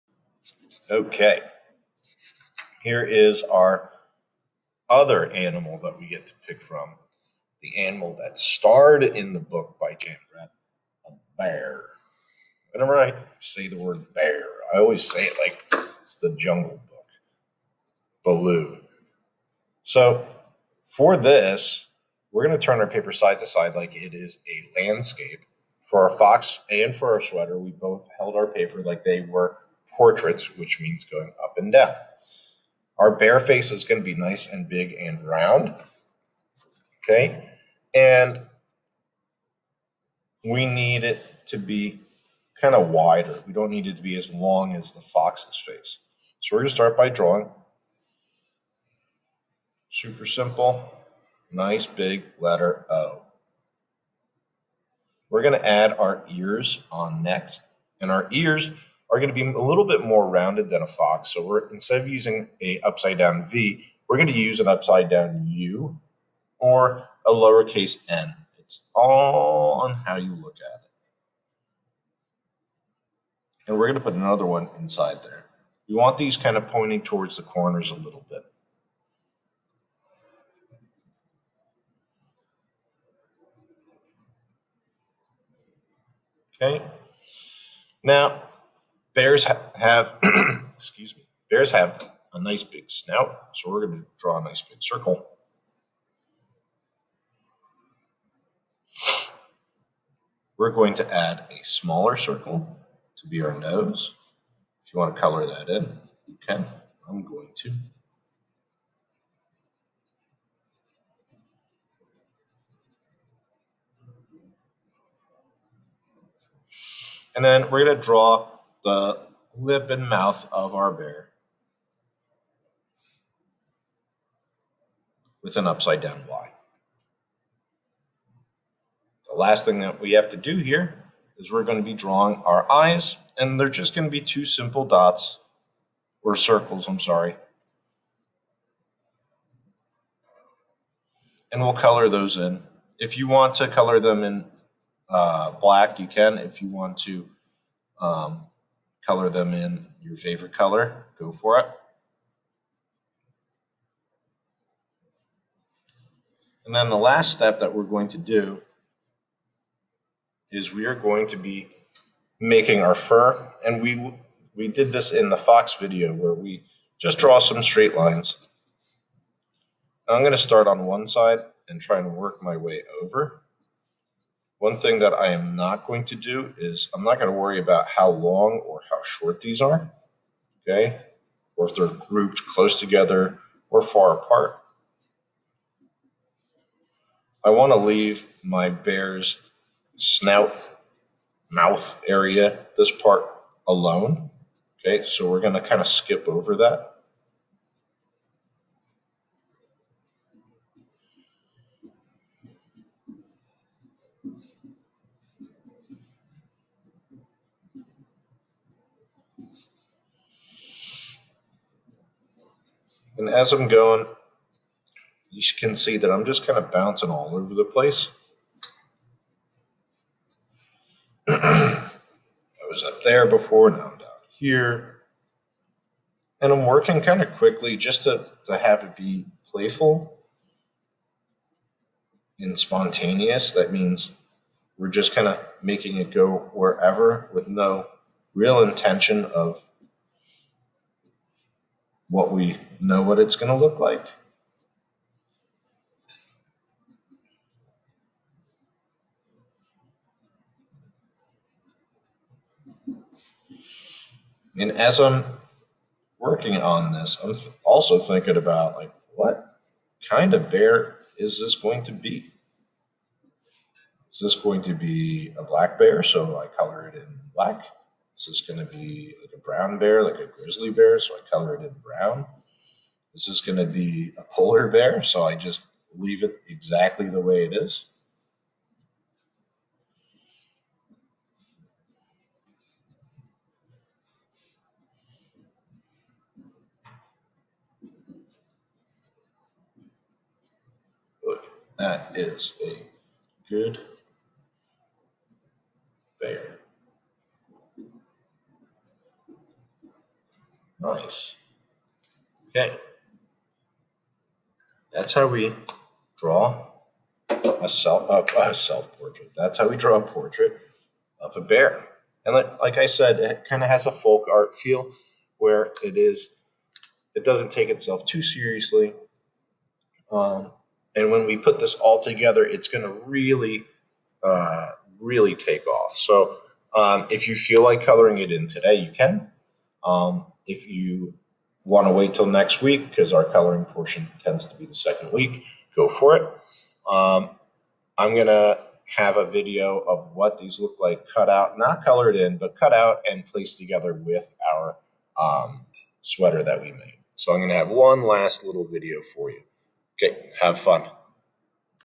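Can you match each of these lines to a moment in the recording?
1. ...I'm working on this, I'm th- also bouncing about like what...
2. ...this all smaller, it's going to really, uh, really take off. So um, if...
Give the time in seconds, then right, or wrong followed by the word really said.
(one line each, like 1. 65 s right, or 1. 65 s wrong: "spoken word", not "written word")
1. 254 s wrong: "thinking", not "bouncing"
2. 321 s wrong: "together", not "smaller".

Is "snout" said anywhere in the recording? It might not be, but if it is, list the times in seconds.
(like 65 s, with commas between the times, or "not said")
92 s, 189 s.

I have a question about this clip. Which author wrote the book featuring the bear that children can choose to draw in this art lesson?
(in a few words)
Jan Brett.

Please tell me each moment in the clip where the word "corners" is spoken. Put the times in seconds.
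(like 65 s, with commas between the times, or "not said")
77 s.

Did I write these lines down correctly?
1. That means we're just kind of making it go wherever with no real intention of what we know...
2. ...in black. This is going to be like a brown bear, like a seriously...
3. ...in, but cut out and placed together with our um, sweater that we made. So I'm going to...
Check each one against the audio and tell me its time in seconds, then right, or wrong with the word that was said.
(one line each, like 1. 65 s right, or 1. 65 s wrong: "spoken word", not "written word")
1. 233 s right
2. 266 s wrong: "grizzly", not "seriously"
3. 342 s right.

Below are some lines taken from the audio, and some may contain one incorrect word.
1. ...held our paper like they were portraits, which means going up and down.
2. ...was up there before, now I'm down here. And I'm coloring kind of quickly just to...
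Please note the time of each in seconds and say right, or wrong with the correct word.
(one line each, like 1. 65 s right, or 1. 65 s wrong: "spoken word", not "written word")
1. 28 s right
2. 222 s wrong: "working", not "coloring".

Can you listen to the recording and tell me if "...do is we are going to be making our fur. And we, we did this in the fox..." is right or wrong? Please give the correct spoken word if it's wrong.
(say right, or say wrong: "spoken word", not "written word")
right.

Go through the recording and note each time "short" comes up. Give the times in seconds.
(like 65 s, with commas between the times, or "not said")
179 s.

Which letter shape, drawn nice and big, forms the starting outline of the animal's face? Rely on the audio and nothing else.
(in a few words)
letter O.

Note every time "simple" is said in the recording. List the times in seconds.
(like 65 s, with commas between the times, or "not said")
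50 s, 134 s.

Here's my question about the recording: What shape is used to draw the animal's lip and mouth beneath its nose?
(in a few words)
upside down Y.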